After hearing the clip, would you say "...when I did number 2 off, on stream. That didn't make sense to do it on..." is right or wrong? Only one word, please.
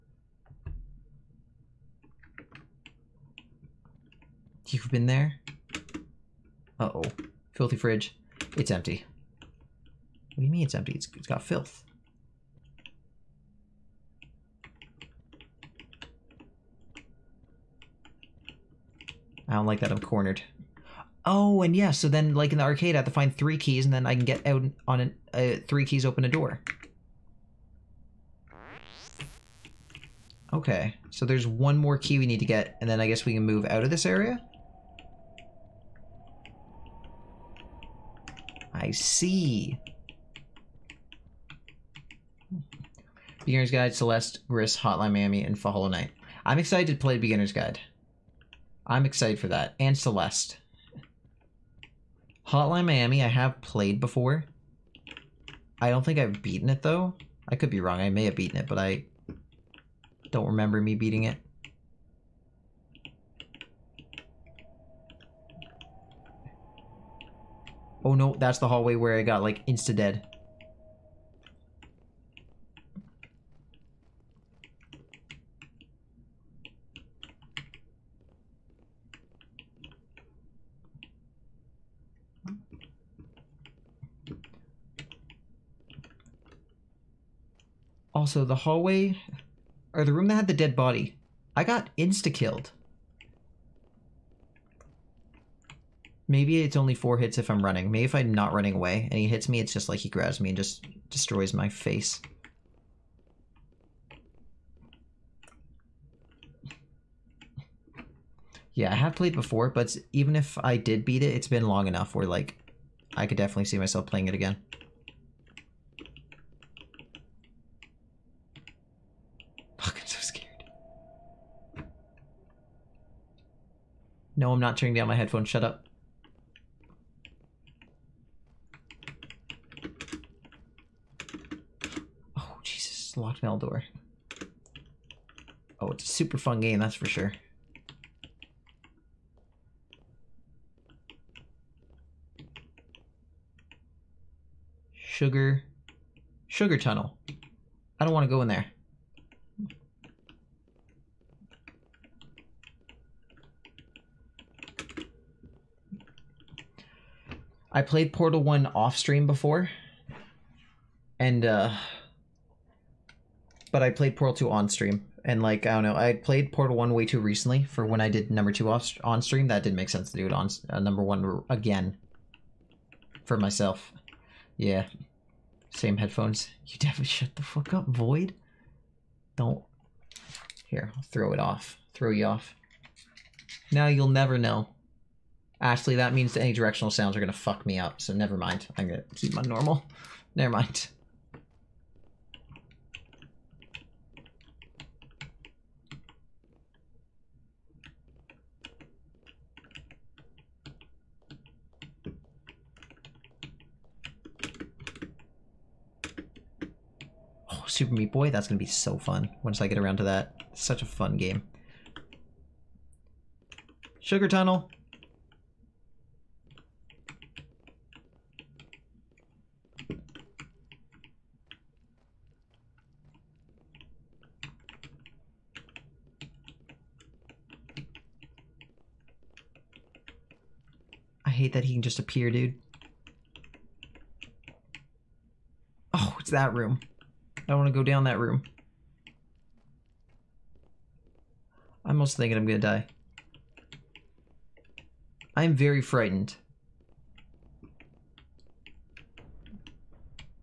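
right.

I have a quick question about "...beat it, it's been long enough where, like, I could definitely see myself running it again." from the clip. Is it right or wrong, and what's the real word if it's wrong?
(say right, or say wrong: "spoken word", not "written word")
wrong: "playing", not "running".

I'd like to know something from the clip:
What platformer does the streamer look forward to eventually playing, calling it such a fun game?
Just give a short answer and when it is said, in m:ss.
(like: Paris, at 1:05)
Super Meat Boy, at 3:27.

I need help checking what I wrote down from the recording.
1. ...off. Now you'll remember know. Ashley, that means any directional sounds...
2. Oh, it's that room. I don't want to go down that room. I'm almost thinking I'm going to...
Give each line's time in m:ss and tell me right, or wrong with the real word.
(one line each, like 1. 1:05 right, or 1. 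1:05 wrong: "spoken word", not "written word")
1. 3:02 wrong: "never", not "remember"
2. 3:55 right.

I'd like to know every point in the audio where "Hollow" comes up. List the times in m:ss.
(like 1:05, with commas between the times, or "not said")
0:45.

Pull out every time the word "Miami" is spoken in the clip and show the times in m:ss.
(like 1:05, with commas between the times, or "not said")
0:45, 0:52.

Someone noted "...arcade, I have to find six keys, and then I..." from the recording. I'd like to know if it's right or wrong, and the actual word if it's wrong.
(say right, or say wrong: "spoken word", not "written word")
wrong: "three", not "six".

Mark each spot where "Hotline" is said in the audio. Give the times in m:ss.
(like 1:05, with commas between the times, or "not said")
0:44, 0:52.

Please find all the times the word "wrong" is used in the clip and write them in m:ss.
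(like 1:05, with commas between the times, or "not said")
0:57.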